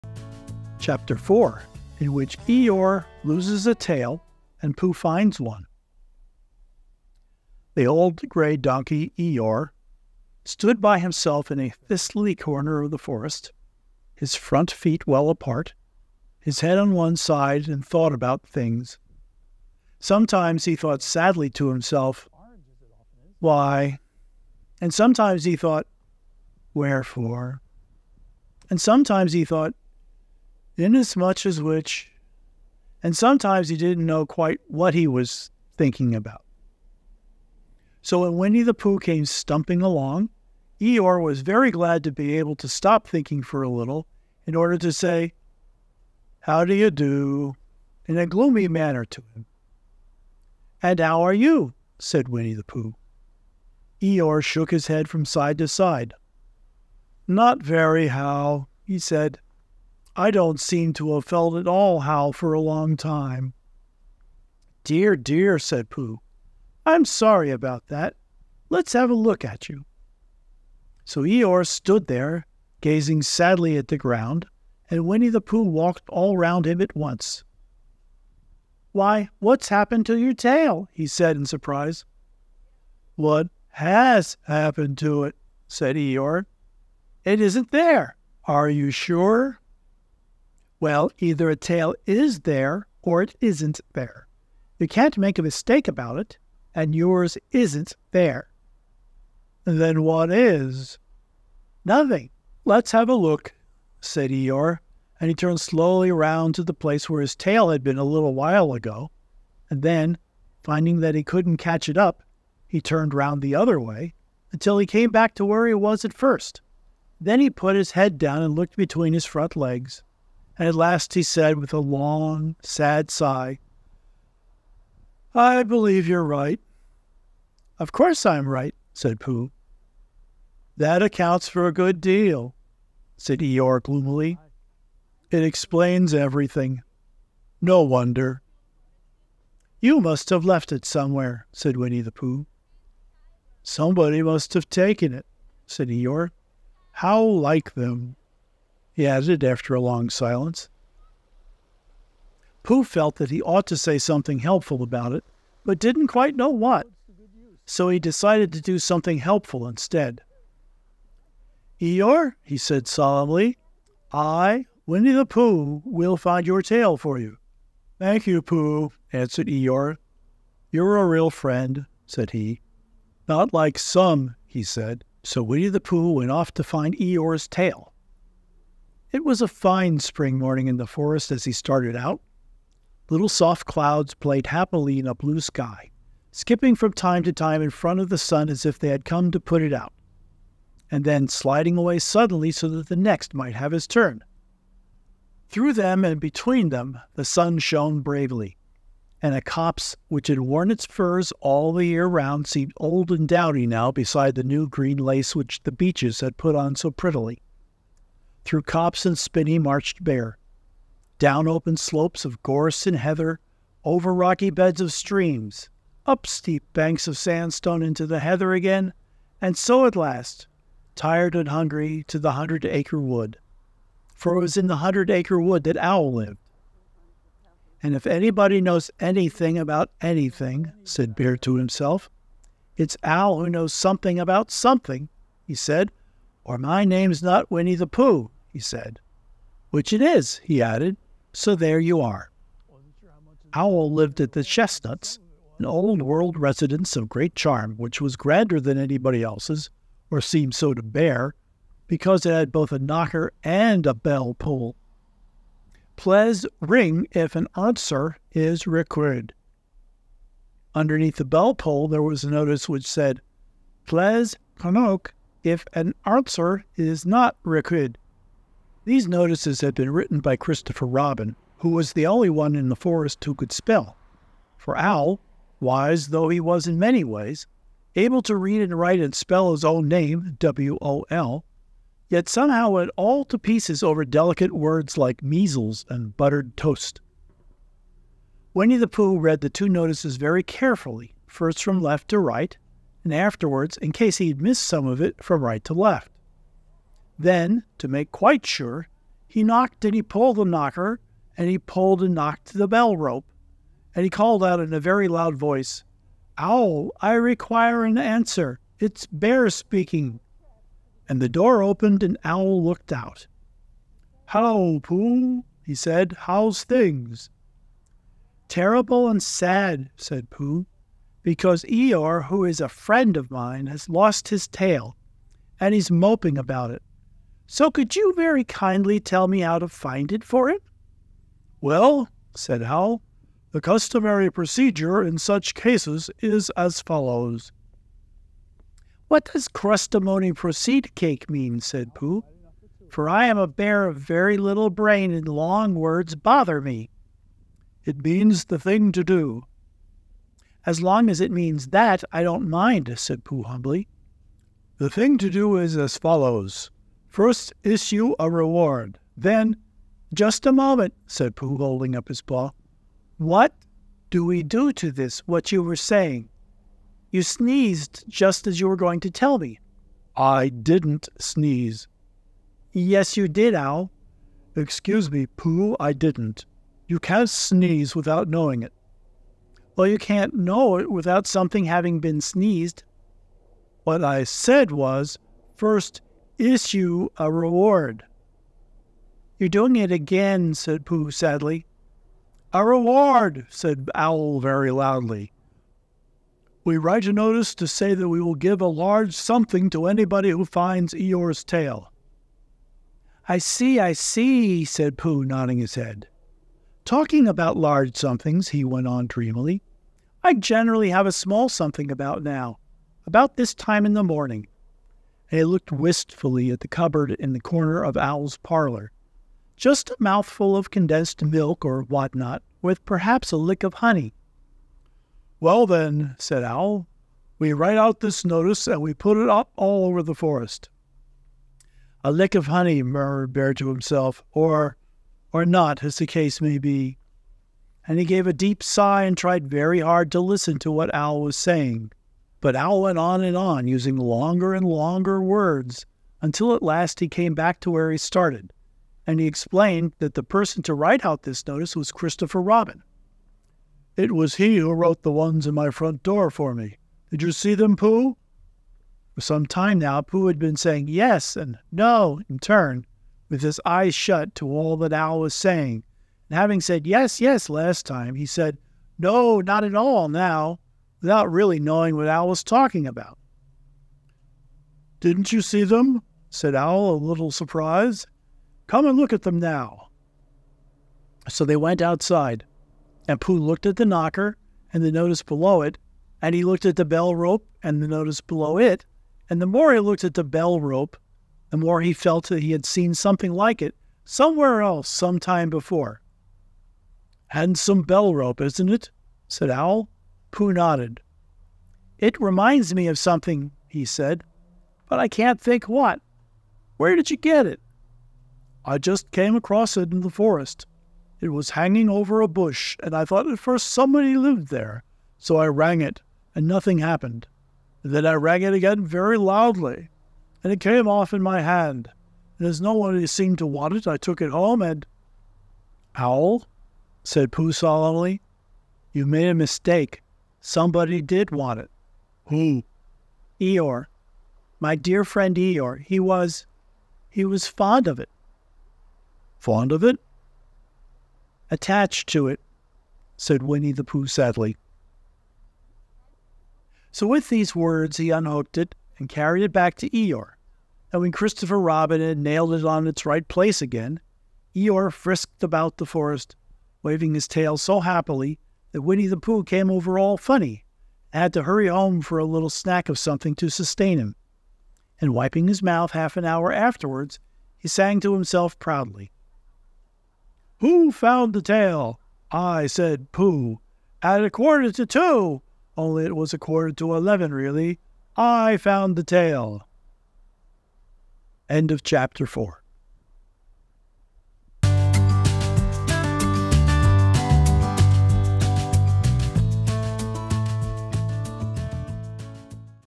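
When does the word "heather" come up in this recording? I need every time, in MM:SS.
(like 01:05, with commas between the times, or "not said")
03:32, 03:38.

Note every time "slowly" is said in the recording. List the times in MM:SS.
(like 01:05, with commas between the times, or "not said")
01:45.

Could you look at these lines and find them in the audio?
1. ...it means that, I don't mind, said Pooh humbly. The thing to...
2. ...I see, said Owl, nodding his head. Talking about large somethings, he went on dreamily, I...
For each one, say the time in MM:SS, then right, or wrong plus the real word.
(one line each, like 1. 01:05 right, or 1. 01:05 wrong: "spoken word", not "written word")
1. 05:51 right
2. 06:43 wrong: "Pooh", not "Owl".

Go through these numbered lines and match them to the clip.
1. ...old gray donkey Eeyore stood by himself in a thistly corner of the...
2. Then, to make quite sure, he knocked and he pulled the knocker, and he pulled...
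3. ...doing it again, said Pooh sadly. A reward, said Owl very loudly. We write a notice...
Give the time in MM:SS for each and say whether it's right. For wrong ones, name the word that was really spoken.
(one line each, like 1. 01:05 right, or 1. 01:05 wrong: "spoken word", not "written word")
1. 00:07 right
2. 04:57 right
3. 06:29 right.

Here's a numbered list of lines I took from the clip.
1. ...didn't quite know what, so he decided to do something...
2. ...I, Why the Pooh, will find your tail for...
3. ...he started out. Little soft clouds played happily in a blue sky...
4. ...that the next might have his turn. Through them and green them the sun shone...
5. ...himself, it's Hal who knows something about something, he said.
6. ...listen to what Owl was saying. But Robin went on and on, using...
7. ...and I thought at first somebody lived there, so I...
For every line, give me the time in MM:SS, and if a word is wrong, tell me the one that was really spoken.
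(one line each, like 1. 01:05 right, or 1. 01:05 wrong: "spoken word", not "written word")
1. 02:35 right
2. 02:44 wrong: "Winnie", not "Why"
3. 03:01 right
4. 03:12 wrong: "between", not "green"
5. 03:51 wrong: "Owl", not "Hal"
6. 07:20 wrong: "Owl", not "Robin"
7. 08:32 right.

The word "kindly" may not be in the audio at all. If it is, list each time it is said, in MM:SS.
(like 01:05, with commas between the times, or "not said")
05:28.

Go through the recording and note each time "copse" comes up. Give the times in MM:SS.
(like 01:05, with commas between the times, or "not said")
03:19, 03:28.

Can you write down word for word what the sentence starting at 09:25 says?
And wiping his mouth half an hour afterwards, he sang to himself proudly.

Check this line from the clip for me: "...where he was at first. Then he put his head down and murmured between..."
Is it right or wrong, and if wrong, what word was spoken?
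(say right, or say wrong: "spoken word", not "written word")
wrong: "looked", not "murmured".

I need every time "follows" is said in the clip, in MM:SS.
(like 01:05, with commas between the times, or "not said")
05:36, 05:55.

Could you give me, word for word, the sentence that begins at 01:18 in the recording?
Why, what's happened to your tail?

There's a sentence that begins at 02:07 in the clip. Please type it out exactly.
Of course I'm right, said Pooh.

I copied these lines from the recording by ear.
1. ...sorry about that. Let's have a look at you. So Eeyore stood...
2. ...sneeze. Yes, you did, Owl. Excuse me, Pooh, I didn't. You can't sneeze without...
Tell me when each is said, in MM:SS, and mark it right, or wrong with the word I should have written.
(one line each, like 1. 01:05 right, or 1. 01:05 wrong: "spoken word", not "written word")
1. 01:07 right
2. 06:11 right.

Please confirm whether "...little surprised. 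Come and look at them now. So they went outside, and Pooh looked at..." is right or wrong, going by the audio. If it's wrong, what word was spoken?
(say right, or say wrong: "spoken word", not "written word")
right.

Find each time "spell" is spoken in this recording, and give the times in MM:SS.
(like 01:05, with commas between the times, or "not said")
04:33, 04:39.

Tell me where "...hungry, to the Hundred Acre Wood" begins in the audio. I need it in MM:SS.
03:41.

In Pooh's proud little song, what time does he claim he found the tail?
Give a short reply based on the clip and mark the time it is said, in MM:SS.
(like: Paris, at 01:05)
a quarter to two, at 09:34.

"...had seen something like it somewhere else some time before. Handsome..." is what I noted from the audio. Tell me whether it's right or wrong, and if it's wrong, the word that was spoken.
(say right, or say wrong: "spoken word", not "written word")
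right.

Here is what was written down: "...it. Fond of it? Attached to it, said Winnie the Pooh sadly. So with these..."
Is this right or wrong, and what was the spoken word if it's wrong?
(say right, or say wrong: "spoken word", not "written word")
right.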